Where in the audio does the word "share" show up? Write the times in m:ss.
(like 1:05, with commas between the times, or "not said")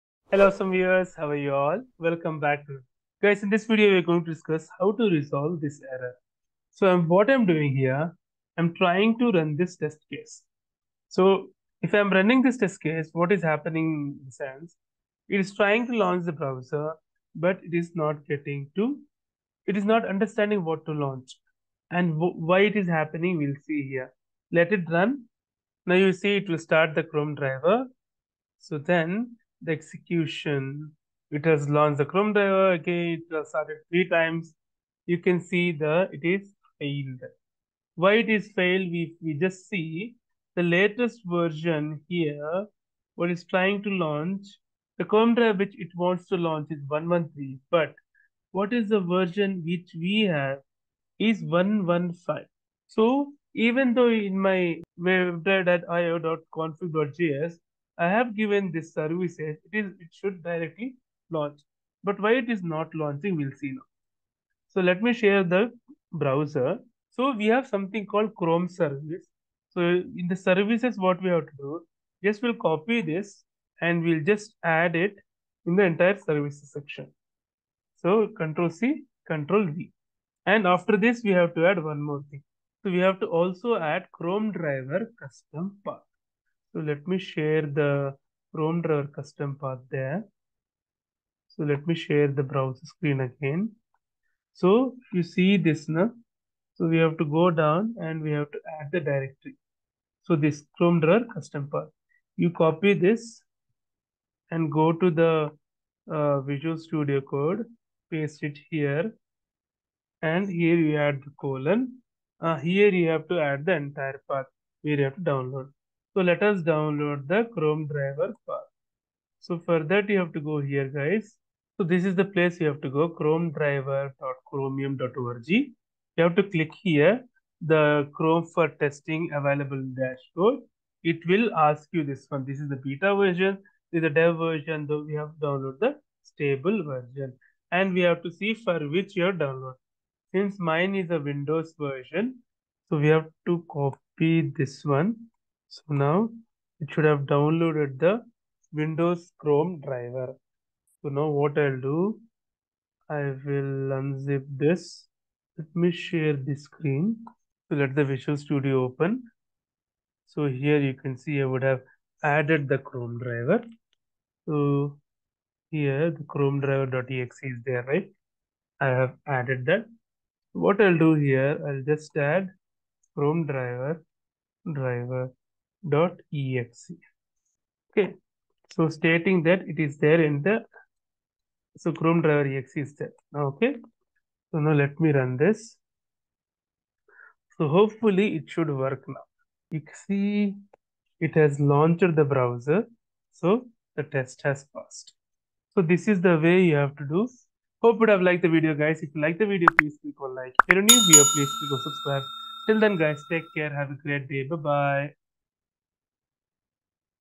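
1:05, 1:27, 1:31, 2:35.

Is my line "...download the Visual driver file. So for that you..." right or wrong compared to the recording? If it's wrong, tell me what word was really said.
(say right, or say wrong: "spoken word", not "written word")
wrong: "Chrome", not "Visual".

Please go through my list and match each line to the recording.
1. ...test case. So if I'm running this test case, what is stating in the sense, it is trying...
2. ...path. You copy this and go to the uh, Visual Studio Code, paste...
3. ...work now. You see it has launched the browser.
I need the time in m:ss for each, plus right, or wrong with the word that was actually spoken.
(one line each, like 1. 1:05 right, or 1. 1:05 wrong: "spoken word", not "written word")
1. 0:09 wrong: "happening", not "stating"
2. 1:41 right
3. 3:08 right.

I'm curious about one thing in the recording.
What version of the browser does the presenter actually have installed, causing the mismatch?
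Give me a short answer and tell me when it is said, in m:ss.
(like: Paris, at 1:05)
115, at 0:51.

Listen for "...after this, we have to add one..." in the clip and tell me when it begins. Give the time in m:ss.
1:20.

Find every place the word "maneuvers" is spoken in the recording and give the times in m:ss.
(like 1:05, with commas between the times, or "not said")
not said.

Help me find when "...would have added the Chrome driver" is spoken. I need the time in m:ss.
2:41.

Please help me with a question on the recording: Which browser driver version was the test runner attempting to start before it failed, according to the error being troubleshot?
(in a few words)
113.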